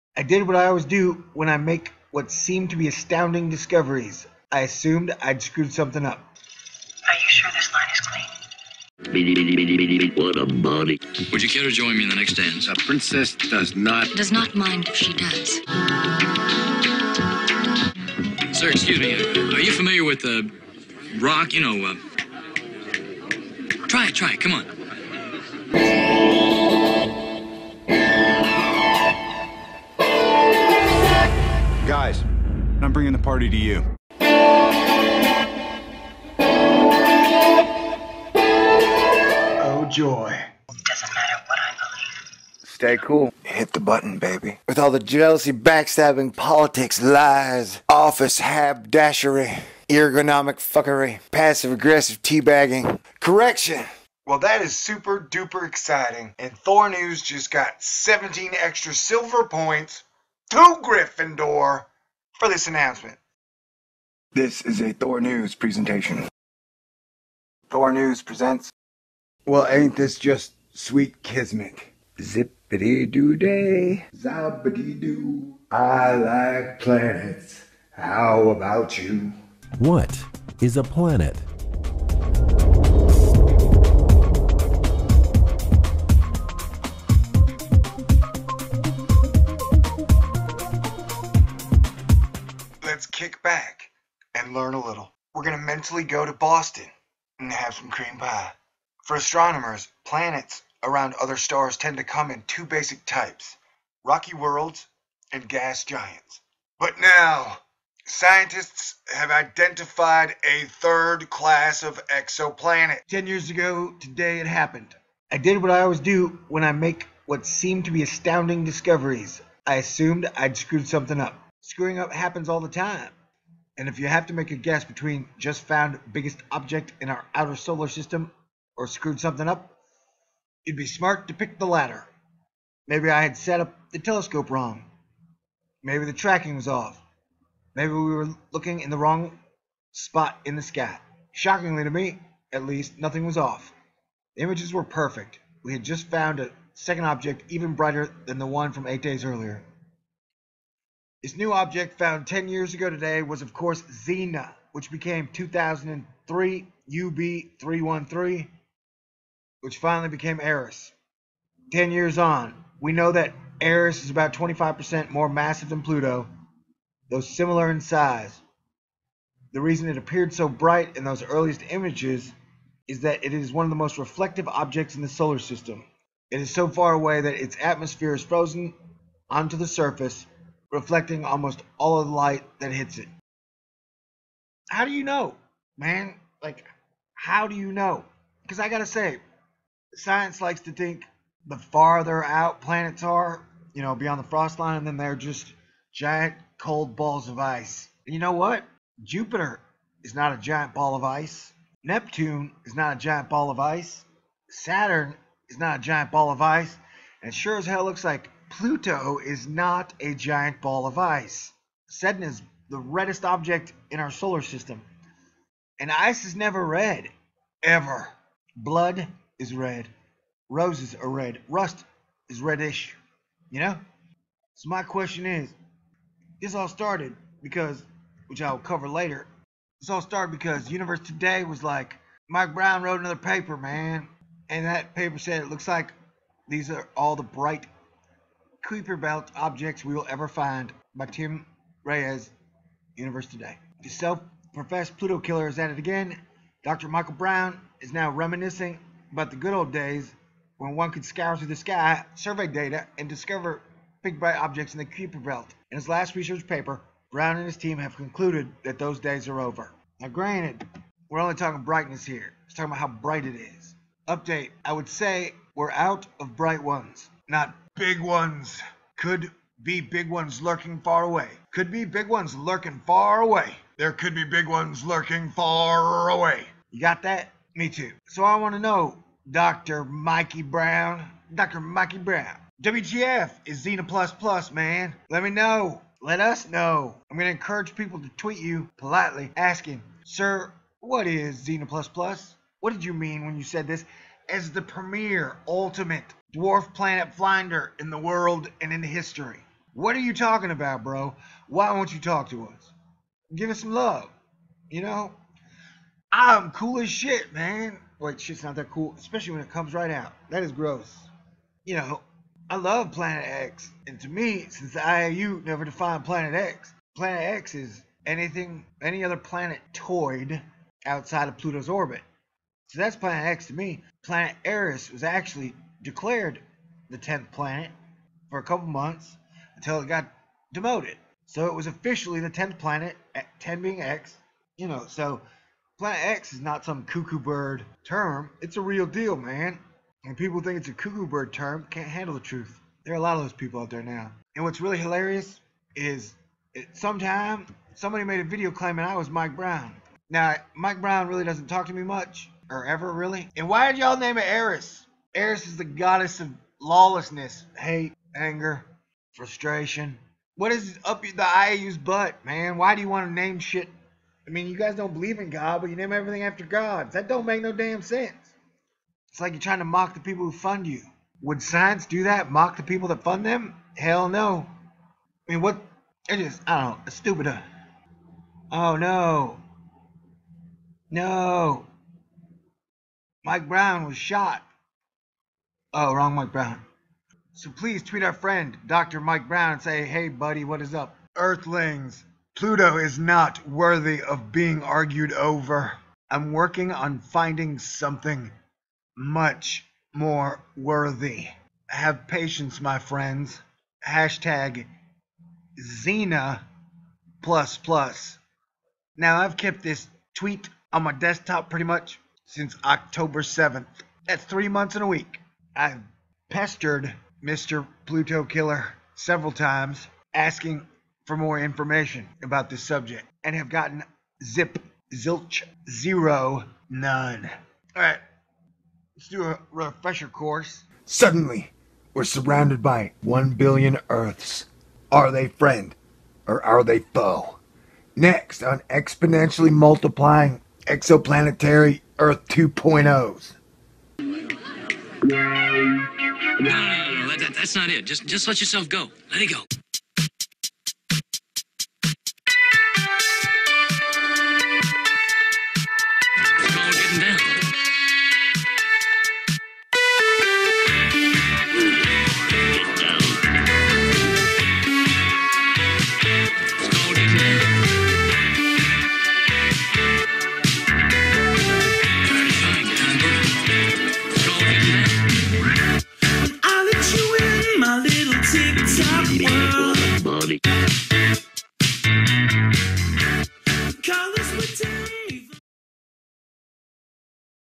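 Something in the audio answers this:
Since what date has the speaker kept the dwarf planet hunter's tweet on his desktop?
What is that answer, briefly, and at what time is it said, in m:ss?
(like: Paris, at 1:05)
October 7th, at 6:52.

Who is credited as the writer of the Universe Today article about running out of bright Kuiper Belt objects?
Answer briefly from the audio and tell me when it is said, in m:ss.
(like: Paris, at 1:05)
Tim Reyes, at 4:01.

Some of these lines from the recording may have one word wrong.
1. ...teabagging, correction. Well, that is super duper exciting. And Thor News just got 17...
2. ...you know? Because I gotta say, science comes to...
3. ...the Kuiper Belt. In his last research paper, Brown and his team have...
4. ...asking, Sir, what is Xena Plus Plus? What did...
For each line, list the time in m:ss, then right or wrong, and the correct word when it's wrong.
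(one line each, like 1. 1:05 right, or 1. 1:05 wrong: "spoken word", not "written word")
1. 0:52 right
2. 3:07 wrong: "likes", not "comes"
3. 4:14 right
4. 4:49 right.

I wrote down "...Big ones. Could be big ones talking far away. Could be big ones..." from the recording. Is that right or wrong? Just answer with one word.
wrong.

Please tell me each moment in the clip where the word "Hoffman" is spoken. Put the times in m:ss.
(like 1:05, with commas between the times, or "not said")
not said.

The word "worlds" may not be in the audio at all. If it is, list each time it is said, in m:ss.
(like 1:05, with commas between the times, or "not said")
1:44, 4:57.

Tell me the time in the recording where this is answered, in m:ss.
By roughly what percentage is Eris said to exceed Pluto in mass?
2:44.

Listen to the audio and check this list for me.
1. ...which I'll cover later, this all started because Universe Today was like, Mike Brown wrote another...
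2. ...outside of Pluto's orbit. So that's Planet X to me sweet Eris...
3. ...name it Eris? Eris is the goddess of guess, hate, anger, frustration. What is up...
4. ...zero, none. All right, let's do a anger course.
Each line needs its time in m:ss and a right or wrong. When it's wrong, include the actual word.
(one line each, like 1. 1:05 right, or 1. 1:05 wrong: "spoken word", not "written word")
1. 3:48 right
2. 5:20 wrong: "planet", not "sweet"
3. 5:53 wrong: "lawlessness", not "guess"
4. 7:05 wrong: "refresher", not "anger".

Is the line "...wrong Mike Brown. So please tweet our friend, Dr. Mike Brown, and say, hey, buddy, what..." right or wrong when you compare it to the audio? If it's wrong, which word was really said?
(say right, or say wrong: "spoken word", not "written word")
right.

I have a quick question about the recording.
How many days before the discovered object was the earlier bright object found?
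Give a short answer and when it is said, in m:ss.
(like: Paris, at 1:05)
8, at 2:28.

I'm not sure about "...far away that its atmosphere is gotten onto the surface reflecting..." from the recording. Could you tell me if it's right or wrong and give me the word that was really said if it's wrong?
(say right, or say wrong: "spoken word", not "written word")
wrong: "frozen", not "gotten".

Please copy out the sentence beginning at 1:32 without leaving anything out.
let's kick back and learn a little.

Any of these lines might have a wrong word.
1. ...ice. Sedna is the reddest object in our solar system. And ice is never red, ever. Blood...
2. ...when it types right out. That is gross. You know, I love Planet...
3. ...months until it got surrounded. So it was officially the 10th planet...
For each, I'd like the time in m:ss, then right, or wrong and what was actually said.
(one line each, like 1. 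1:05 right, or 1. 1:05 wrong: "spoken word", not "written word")
1. 3:30 right
2. 5:09 wrong: "comes", not "types"
3. 5:28 wrong: "demoted", not "surrounded".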